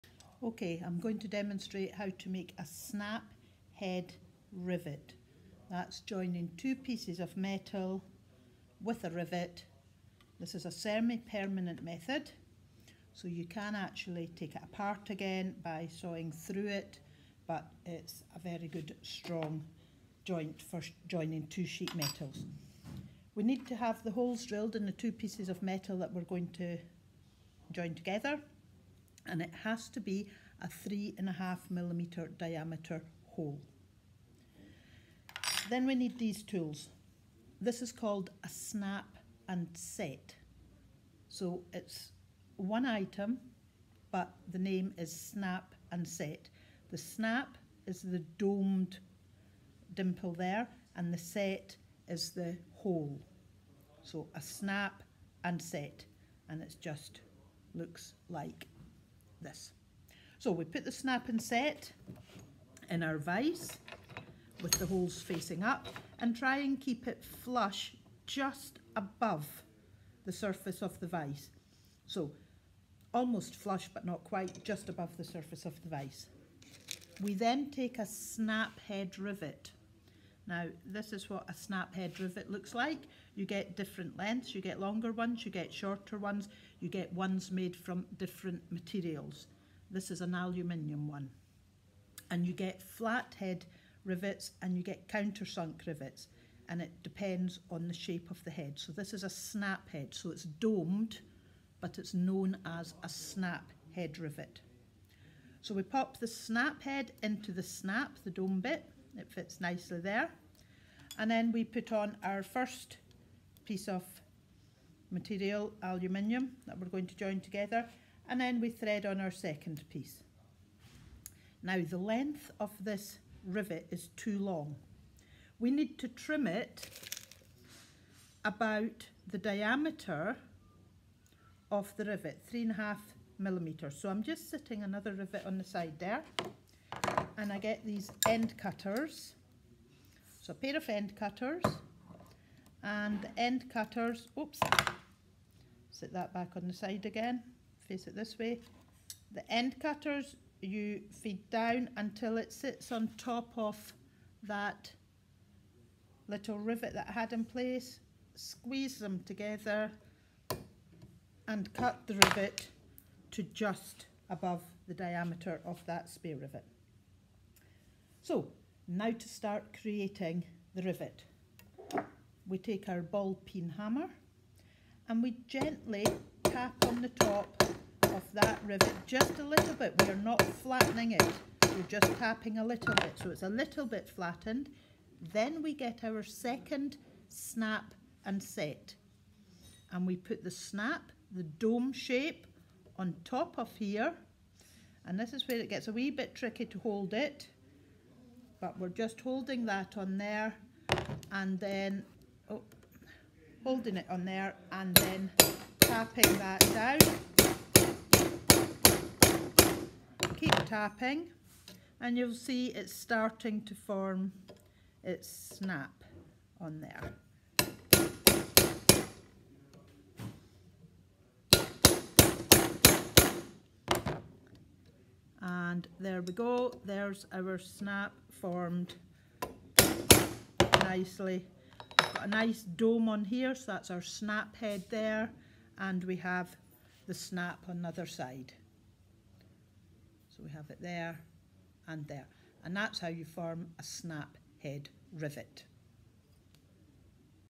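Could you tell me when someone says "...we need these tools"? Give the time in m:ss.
0:35.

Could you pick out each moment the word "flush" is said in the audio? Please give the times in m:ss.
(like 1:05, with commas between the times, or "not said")
1:07, 1:13.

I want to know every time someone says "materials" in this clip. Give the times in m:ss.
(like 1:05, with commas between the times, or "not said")
1:28, 1:55.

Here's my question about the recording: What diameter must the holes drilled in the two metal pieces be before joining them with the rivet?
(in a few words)
3.5 millimeters.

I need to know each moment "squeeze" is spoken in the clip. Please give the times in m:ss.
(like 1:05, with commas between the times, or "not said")
2:38.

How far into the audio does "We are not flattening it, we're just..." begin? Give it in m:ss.
3:00.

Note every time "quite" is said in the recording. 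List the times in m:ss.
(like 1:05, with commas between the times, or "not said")
1:14.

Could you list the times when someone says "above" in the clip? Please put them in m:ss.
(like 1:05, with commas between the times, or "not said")
1:08, 1:14, 2:44.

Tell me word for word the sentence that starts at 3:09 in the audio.
And we put the snap, the dome shape, on top of here.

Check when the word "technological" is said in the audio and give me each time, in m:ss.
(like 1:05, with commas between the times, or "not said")
not said.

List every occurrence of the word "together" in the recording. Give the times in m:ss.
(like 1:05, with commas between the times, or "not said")
0:27, 1:57, 2:39.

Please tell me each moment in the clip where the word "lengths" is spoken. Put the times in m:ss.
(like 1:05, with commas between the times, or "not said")
1:24, 2:01.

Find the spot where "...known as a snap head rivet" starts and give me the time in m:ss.
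1:42.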